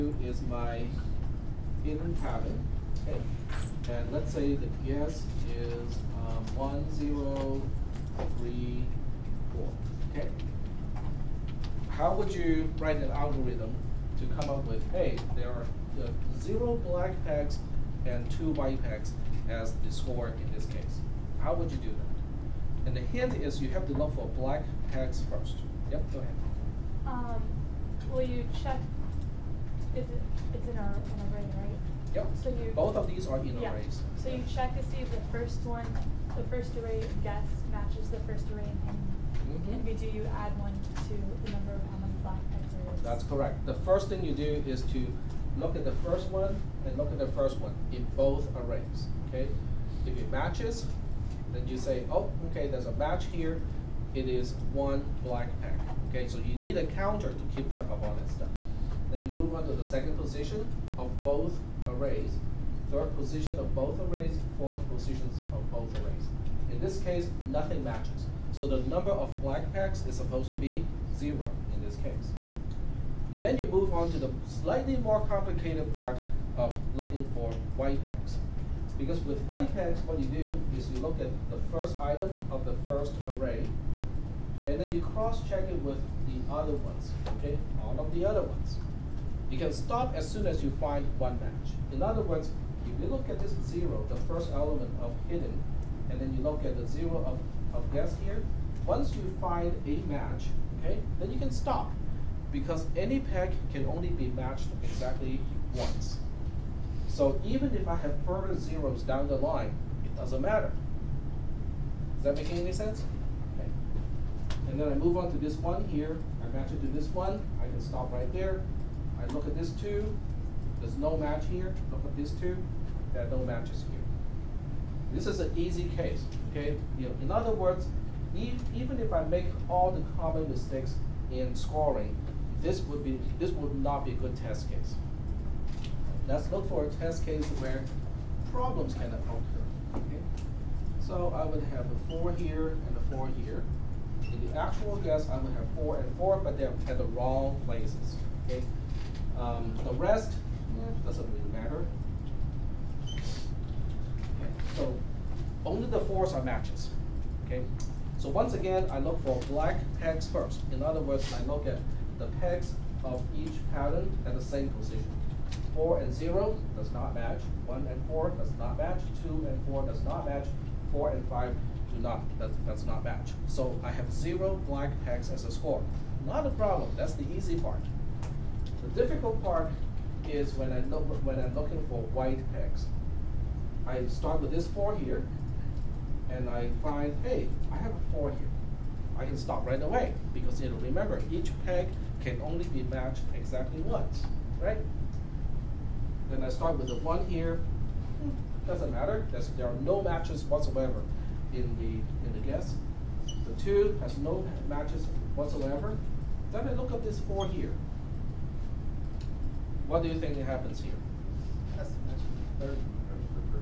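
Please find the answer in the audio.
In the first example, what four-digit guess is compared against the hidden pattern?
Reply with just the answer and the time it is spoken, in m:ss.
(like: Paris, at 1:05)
1034, at 0:06.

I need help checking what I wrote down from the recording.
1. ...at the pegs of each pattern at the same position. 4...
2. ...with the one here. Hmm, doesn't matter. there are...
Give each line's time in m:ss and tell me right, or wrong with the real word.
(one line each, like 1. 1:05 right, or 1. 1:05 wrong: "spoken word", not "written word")
1. 2:41 right
2. 3:16 right.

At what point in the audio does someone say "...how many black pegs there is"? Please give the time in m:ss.
0:41.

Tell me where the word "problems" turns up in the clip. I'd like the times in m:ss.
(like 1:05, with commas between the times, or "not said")
2:18, 2:56.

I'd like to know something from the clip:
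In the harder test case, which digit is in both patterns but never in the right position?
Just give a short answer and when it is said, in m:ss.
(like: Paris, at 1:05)
4, at 2:36.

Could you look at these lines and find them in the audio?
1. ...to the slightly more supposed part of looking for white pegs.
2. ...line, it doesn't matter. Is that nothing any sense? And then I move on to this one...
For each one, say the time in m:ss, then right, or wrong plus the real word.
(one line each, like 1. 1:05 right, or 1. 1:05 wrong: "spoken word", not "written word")
1. 1:14 wrong: "complicated", not "supposed"
2. 1:49 wrong: "making", not "nothing".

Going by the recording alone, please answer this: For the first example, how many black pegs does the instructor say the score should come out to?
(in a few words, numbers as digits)
0.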